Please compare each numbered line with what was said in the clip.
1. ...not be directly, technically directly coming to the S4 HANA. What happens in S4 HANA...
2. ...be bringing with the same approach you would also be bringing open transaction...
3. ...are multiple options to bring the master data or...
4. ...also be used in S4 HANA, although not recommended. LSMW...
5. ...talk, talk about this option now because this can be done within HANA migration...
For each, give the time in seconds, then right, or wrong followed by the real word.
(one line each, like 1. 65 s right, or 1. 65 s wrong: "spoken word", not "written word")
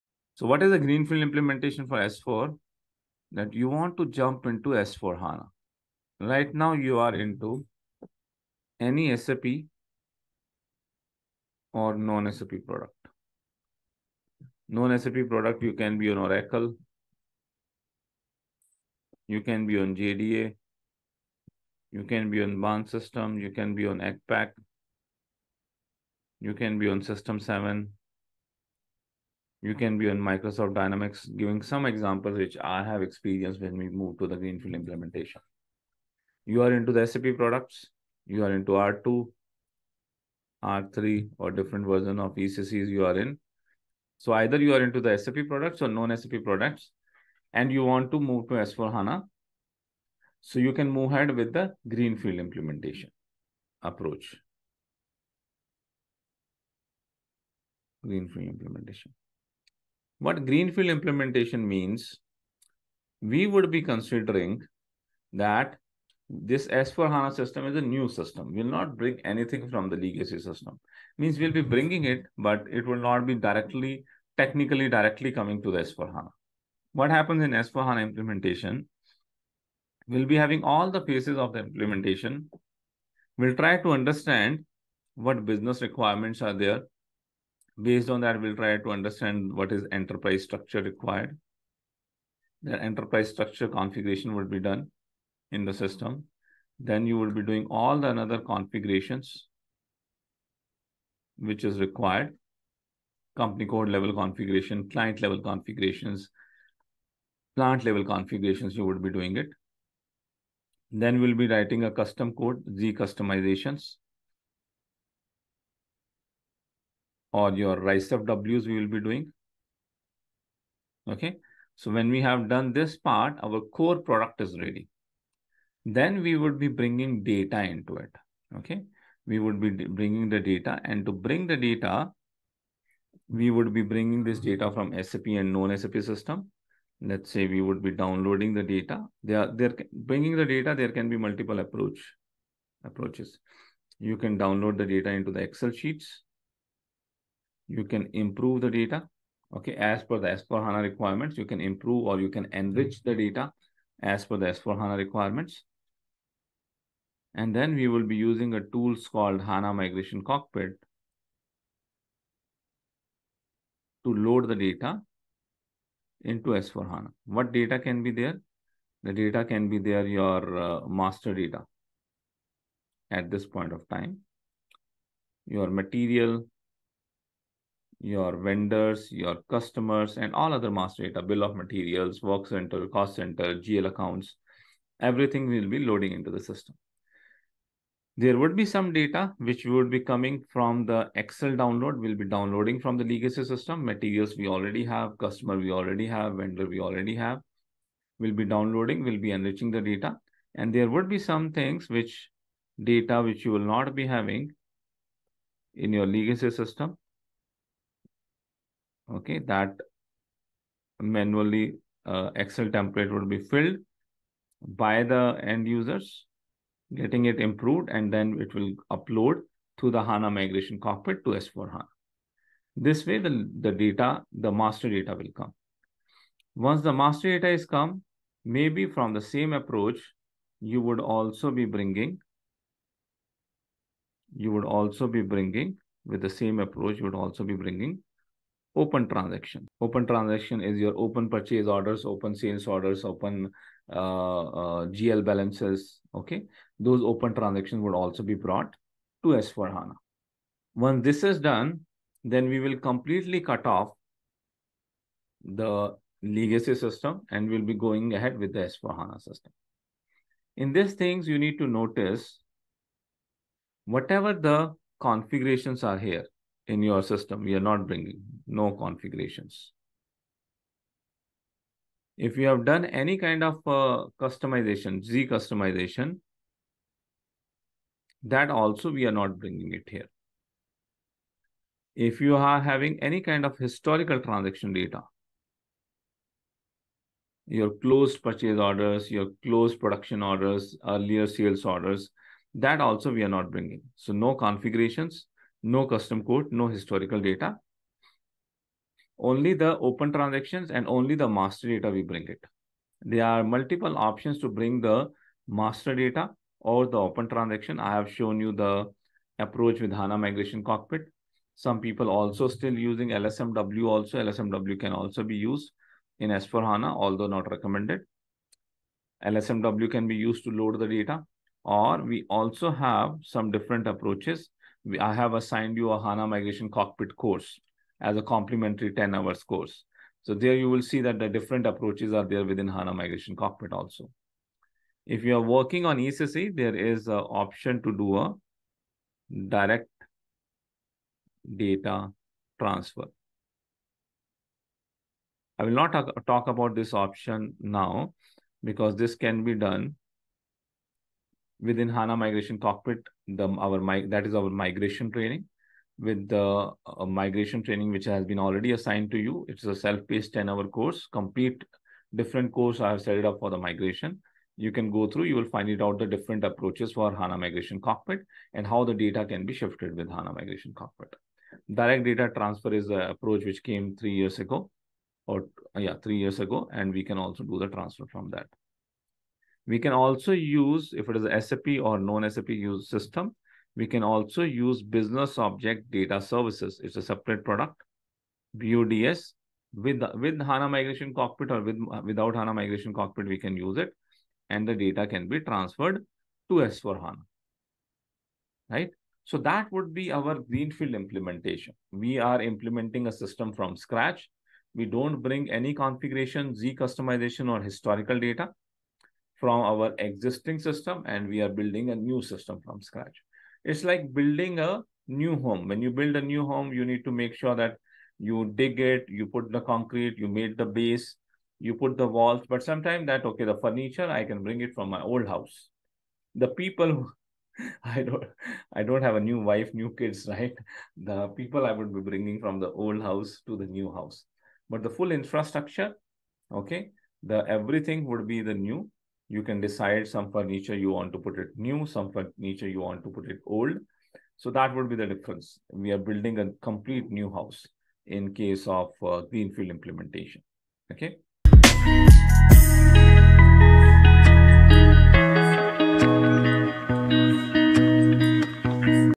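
1. 73 s right
2. 235 s right
3. 303 s right
4. 314 s right
5. 345 s right.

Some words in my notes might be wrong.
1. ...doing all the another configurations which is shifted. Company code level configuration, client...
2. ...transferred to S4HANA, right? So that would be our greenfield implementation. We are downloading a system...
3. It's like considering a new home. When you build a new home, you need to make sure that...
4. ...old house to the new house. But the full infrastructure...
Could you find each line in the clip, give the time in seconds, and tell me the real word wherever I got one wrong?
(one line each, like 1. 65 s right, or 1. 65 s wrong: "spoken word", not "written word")
1. 97 s wrong: "required", not "shifted"
2. 395 s wrong: "implementing", not "downloading"
3. 413 s wrong: "building", not "considering"
4. 432 s right.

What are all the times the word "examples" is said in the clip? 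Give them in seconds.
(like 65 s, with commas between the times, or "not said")
31 s.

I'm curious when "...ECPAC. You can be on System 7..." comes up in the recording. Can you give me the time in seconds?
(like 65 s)
23 s.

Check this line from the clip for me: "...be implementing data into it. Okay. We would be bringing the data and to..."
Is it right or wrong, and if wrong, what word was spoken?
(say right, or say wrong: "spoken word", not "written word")
wrong: "bringing", not "implementing".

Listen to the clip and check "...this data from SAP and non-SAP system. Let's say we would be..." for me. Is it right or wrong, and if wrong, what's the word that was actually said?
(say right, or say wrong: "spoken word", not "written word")
right.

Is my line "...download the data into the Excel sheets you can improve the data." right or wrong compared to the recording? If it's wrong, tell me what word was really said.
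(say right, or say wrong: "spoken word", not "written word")
right.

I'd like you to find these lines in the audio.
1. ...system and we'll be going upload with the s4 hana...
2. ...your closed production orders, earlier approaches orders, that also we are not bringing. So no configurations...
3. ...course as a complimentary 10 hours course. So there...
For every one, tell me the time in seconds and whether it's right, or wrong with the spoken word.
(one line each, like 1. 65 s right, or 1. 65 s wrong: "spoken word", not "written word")
1. 256 s wrong: "ahead", not "upload"
2. 289 s wrong: "sales", not "approaches"
3. 327 s right.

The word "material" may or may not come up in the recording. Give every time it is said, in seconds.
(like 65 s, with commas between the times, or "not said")
175 s, 181 s, 193 s.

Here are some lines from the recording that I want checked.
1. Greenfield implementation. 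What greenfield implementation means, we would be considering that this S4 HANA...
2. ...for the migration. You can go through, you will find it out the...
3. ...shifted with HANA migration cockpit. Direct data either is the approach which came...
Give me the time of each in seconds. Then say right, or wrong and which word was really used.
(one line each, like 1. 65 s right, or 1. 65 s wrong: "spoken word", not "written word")
1. 58 s right
2. 363 s right
3. 369 s wrong: "transfer", not "either".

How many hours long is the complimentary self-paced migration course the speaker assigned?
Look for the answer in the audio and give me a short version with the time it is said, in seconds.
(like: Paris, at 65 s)
10, at 360 s.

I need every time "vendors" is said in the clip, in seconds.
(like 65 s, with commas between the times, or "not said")
178 s, 196 s.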